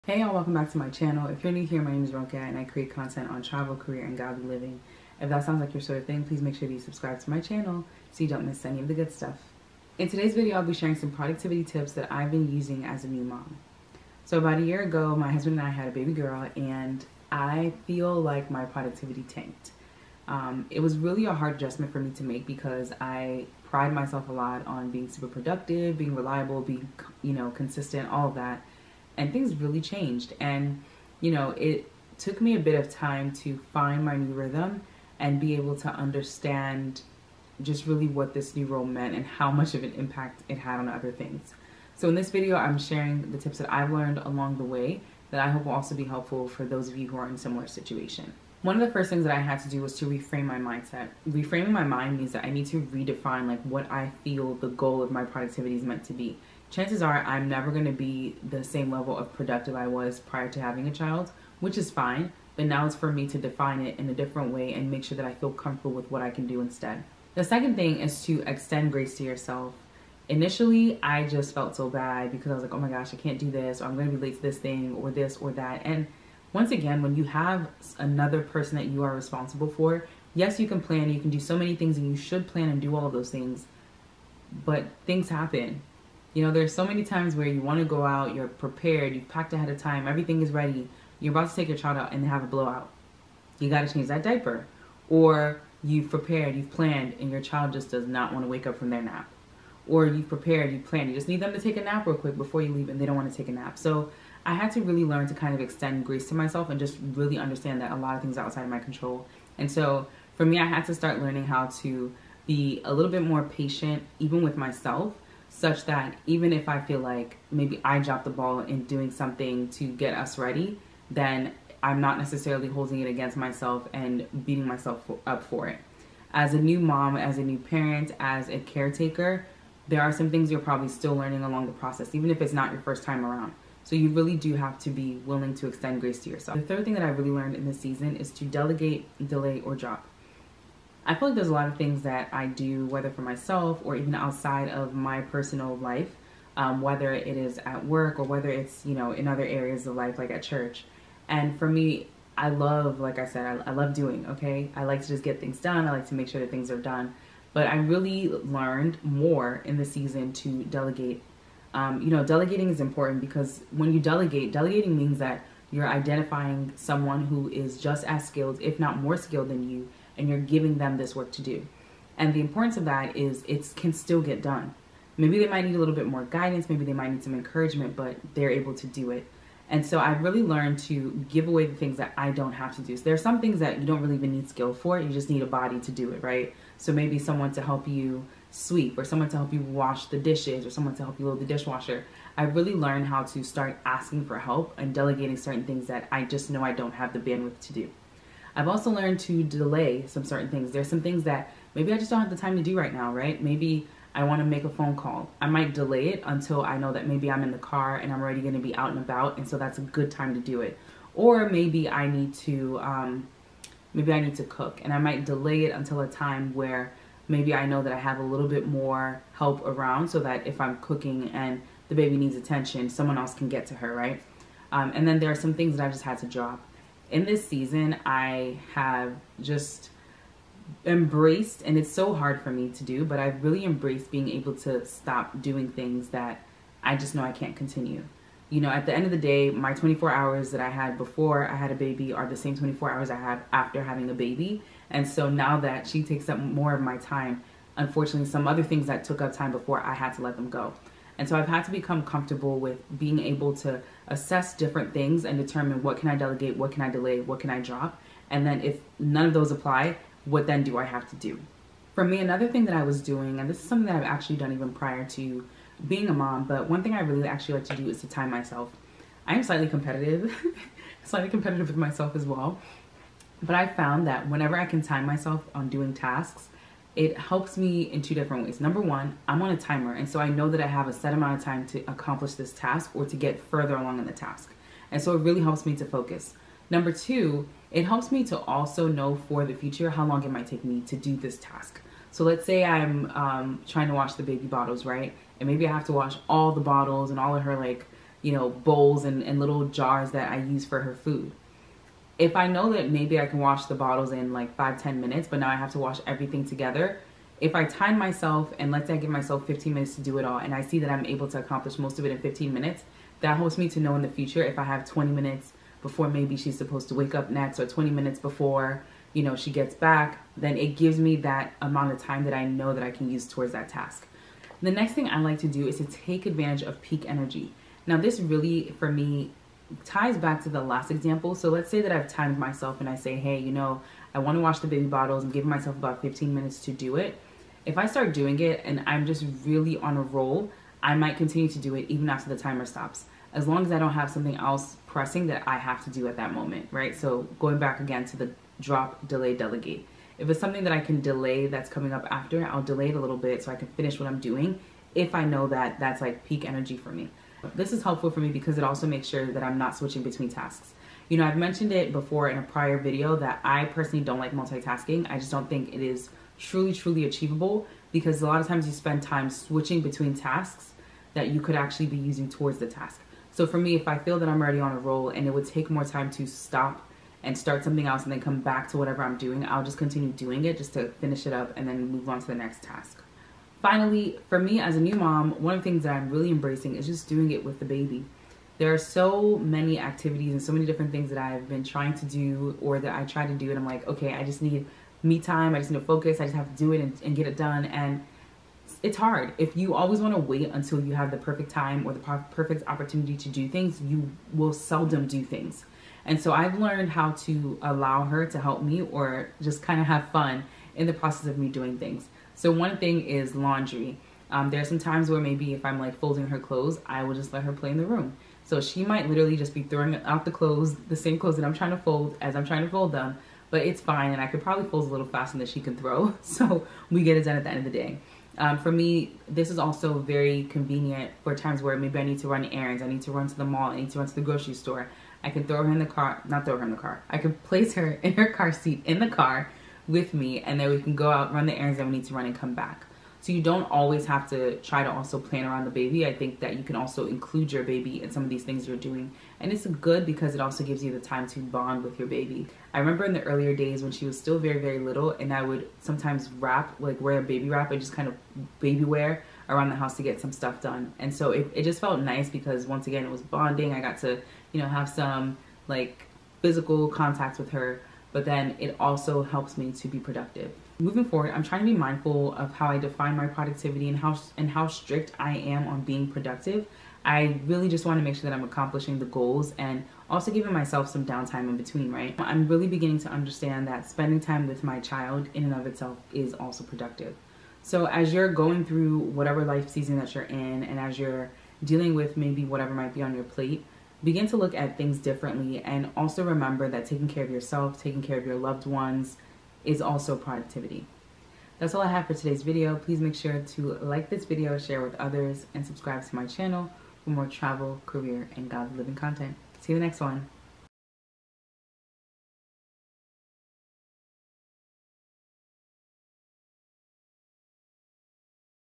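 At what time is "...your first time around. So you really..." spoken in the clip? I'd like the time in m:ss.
2:12.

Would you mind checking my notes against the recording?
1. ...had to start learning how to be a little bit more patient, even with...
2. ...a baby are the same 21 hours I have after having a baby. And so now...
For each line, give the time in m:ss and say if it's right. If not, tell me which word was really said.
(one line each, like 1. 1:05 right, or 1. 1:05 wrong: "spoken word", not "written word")
1. 1:50 right
2. 4:01 wrong: "24", not "21".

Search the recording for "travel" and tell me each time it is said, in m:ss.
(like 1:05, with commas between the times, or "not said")
0:03, 8:27.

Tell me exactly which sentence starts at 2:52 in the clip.
And the importance of that is it can still get done.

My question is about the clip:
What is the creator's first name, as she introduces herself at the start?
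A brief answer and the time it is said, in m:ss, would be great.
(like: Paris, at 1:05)
Ronke, at 0:02.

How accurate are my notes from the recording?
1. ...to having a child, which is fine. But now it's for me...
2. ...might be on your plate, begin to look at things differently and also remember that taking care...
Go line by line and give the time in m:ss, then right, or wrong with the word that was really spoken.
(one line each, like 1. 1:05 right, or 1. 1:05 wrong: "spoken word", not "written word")
1. 1:00 right
2. 8:12 right.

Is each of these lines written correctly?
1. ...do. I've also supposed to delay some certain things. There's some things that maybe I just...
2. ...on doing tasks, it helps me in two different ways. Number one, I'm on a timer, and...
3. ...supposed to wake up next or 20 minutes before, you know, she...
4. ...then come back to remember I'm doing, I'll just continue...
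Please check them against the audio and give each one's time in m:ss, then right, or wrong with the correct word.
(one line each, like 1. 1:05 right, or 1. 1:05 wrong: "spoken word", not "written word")
1. 3:17 wrong: "learned", not "supposed"
2. 4:35 right
3. 5:16 right
4. 6:18 wrong: "whatever", not "remember".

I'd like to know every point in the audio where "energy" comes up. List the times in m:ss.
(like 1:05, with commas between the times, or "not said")
5:27, 5:56.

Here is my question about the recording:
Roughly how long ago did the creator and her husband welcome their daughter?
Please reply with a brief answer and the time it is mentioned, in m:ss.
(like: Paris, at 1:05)
About a year ago, at 0:14.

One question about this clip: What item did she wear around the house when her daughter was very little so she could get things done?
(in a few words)
A baby wrap.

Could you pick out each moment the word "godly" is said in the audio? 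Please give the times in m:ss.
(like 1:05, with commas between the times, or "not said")
0:04, 8:28.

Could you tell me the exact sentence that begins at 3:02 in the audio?
So there are some things that you don't really even need skill for, you just need a body to do it, right?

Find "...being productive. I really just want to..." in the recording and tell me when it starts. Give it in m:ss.
7:55.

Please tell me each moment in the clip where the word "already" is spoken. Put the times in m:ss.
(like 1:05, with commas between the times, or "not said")
3:28, 6:14.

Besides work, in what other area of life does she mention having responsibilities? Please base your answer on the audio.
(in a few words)
Church.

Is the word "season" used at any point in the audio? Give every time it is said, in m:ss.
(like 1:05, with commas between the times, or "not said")
2:17, 2:39, 3:47, 8:09.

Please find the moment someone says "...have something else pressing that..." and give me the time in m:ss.
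5:43.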